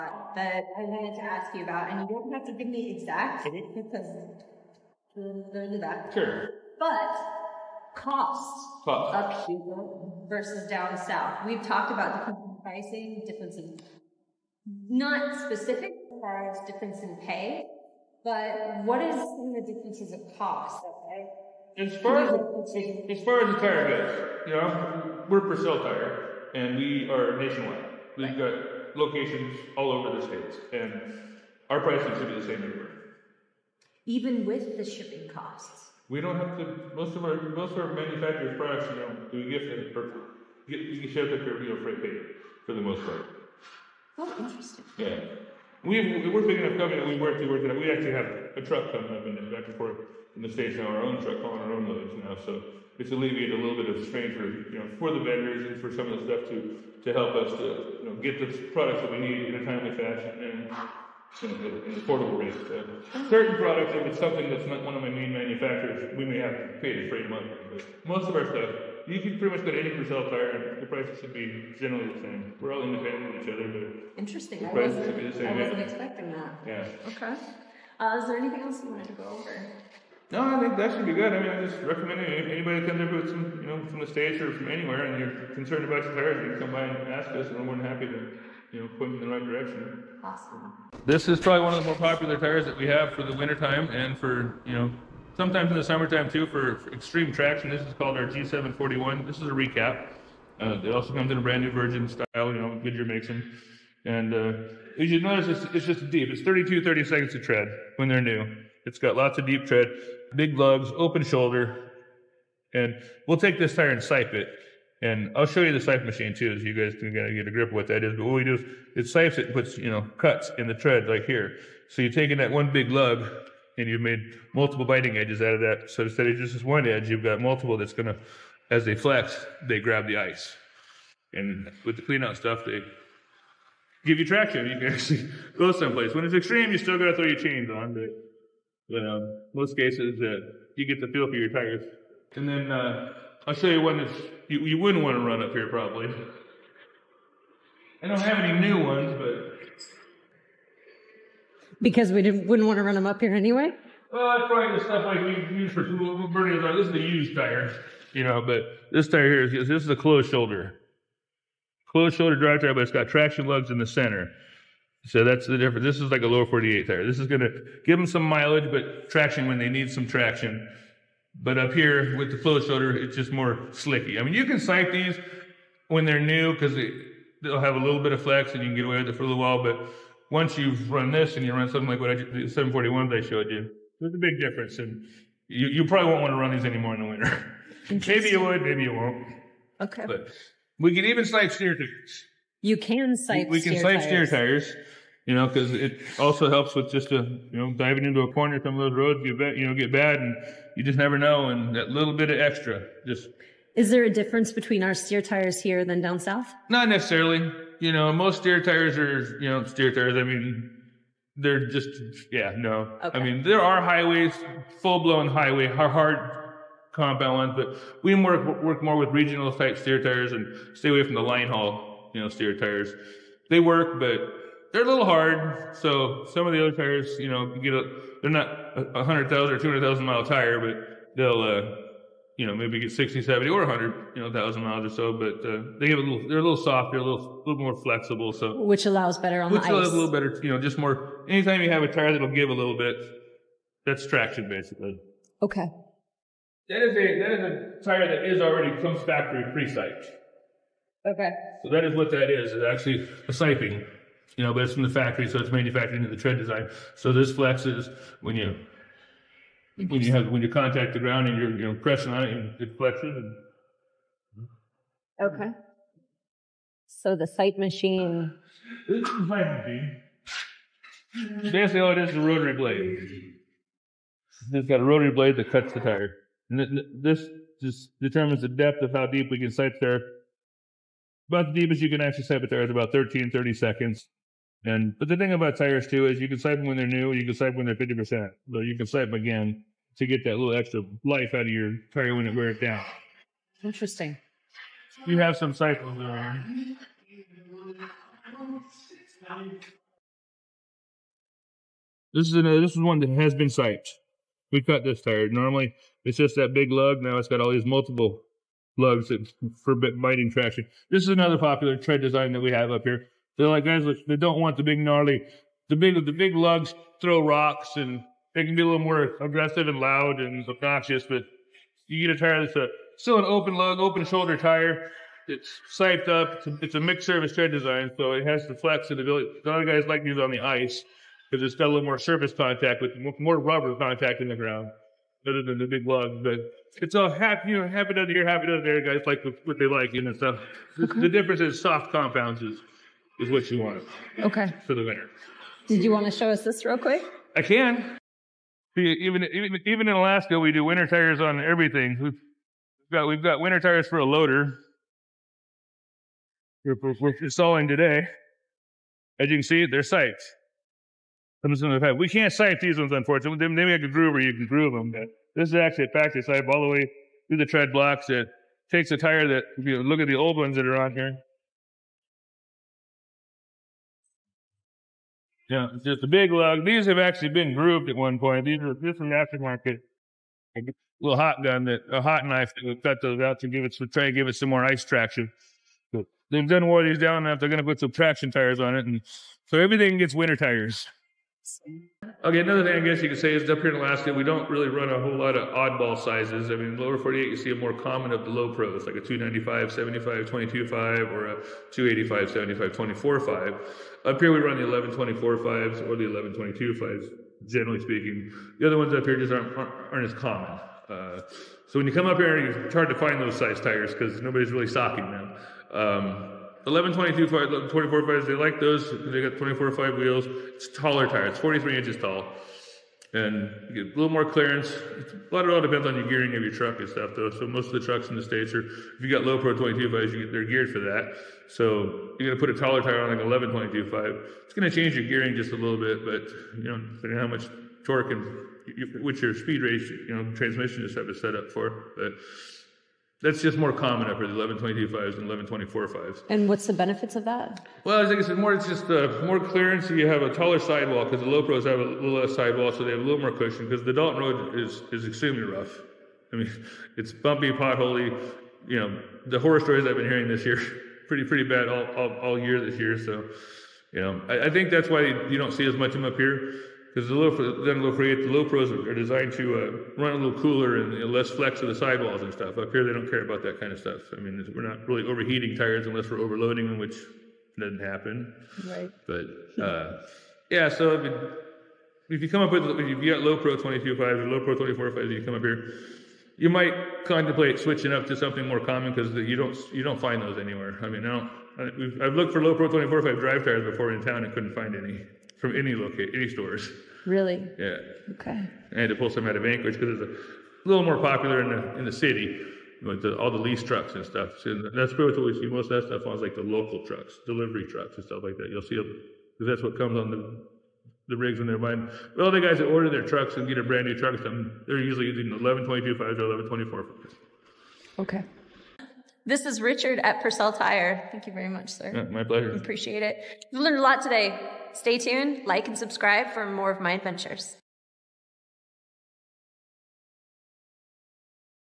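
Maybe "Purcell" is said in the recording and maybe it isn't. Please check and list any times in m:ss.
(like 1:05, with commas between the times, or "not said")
0:25, 1:09, 8:40.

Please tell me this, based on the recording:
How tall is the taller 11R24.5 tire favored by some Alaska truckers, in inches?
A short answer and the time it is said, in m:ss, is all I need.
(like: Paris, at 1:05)
43 inches, at 7:01.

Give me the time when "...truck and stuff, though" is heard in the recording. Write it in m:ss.
7:06.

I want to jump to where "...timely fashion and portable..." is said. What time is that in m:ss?
0:59.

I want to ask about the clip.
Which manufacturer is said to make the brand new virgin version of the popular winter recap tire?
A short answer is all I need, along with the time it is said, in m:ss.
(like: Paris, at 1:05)
Goodyear, at 1:42.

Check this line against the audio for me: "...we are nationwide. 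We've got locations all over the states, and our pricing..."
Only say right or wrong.
right.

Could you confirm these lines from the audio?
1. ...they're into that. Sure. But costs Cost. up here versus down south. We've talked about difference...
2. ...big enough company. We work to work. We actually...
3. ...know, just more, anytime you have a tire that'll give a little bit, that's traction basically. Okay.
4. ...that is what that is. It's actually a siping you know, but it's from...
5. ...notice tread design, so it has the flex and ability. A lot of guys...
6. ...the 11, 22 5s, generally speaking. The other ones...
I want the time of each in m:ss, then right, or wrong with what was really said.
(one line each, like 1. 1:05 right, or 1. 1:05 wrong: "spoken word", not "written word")
1. 0:05 right
2. 0:46 right
3. 4:00 right
4. 4:11 right
5. 5:27 wrong: "service", not "notice"
6. 6:45 right.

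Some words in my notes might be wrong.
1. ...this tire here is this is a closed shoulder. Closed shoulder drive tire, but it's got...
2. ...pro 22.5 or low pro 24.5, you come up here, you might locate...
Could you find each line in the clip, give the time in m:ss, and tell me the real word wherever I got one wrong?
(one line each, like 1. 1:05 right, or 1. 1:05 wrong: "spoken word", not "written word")
1. 2:38 right
2. 8:03 wrong: "contemplate", not "locate".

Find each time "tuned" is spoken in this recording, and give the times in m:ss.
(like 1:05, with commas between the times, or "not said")
8:44.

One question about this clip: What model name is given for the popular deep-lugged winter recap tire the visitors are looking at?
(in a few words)
G741.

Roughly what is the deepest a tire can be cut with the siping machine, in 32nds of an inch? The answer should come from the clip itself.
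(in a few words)
13/32.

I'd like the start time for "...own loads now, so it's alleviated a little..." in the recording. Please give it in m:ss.
0:51.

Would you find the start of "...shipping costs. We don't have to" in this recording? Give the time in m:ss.
0:34.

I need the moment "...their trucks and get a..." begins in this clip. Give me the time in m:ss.
8:32.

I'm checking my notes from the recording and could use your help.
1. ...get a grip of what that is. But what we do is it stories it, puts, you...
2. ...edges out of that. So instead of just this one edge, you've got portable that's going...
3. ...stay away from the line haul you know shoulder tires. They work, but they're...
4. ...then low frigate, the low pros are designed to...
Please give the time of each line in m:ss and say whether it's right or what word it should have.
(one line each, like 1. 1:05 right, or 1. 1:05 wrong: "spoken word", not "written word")
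1. 1:57 wrong: "sipes", not "stories"
2. 2:05 wrong: "multiple", not "portable"
3. 3:40 wrong: "steer", not "shoulder"
4. 7:47 right.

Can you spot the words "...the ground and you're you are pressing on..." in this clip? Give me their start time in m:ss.
4:20.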